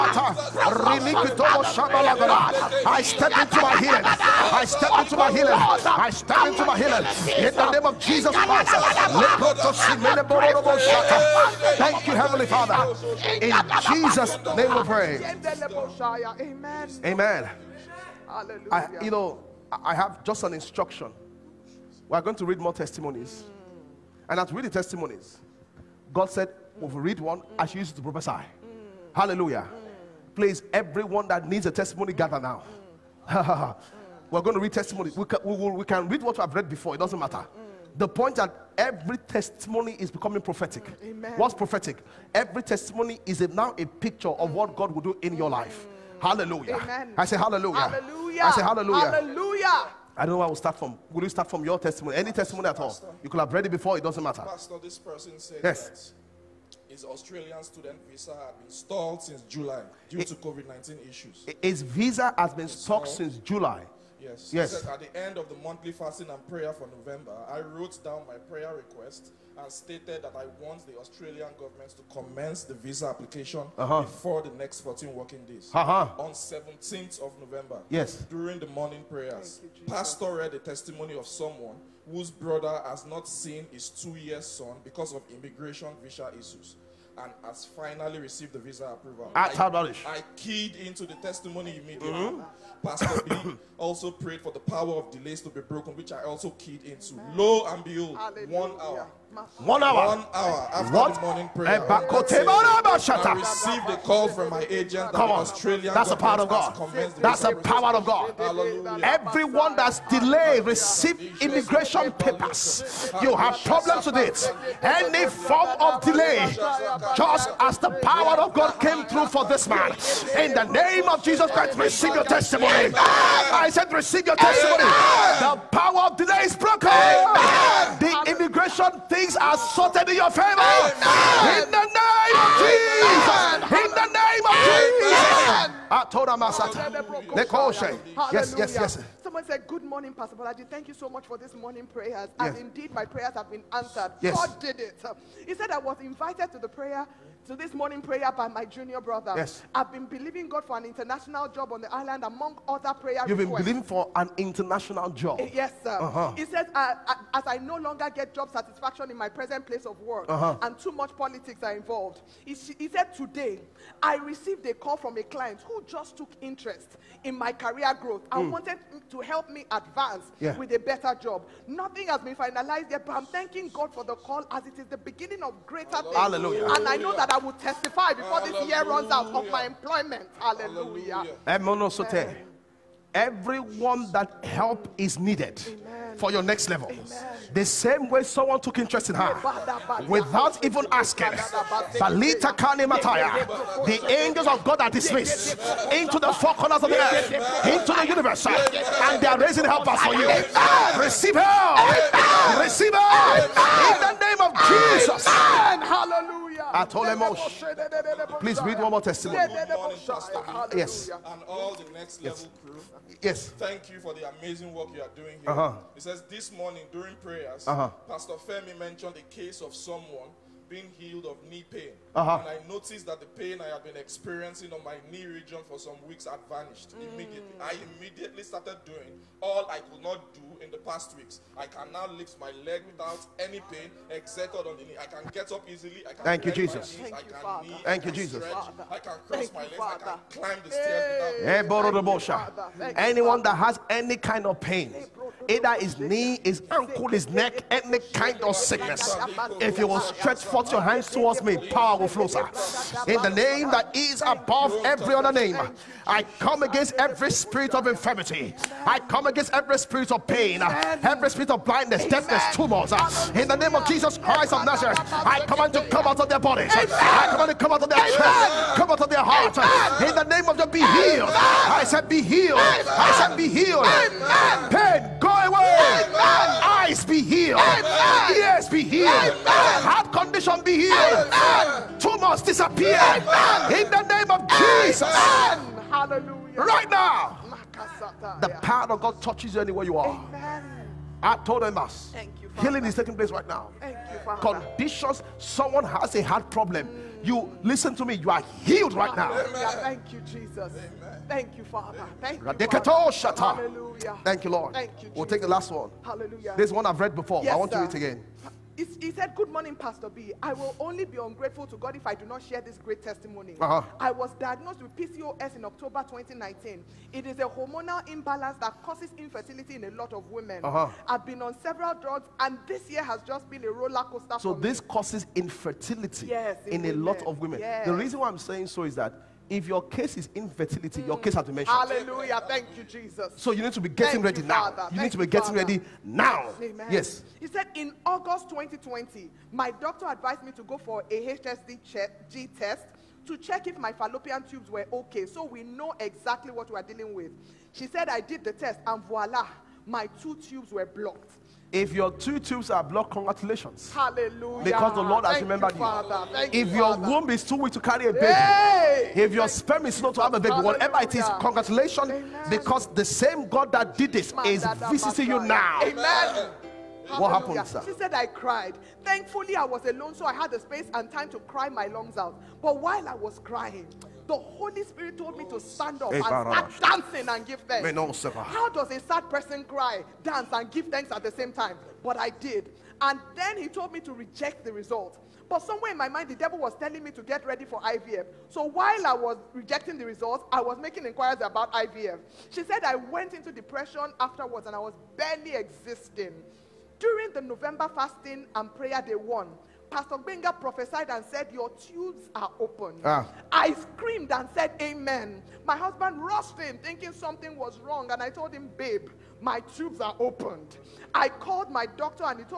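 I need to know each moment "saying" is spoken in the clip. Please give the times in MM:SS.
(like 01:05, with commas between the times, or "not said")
05:28.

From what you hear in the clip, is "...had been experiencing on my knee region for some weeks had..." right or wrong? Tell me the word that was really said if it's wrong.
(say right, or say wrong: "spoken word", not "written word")
right.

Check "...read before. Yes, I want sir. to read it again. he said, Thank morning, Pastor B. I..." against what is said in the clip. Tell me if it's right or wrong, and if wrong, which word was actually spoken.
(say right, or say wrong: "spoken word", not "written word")
wrong: "Good", not "Thank".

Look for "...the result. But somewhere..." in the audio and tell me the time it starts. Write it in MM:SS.
06:24.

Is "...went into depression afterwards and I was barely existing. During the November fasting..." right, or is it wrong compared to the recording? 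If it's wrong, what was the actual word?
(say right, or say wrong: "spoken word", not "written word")
right.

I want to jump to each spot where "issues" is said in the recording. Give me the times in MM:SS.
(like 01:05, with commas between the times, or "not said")
01:01, 01:26.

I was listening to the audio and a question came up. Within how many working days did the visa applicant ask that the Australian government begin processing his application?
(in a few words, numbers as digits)
14.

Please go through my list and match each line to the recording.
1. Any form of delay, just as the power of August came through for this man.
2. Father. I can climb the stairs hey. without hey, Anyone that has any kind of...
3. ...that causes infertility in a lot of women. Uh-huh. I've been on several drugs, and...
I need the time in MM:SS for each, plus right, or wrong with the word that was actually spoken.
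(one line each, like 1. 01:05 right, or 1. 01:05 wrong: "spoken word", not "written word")
1. 01:54 wrong: "God", not "August"
2. 03:59 right
3. 05:18 right.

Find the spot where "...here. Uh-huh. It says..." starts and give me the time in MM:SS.
03:35.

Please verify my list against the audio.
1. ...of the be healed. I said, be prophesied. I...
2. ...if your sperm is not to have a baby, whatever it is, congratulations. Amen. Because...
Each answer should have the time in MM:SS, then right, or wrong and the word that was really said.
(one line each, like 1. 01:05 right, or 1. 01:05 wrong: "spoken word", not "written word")
1. 04:30 wrong: "healed", not "prophesied"
2. 05:59 right.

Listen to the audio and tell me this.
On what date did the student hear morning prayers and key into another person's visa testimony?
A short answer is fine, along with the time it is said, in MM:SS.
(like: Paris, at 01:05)
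17th of November, at 01:16.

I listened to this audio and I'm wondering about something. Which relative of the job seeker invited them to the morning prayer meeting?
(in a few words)
Junior brother.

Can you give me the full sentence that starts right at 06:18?
How does a sad person cry, dance, and give thanks at the same time?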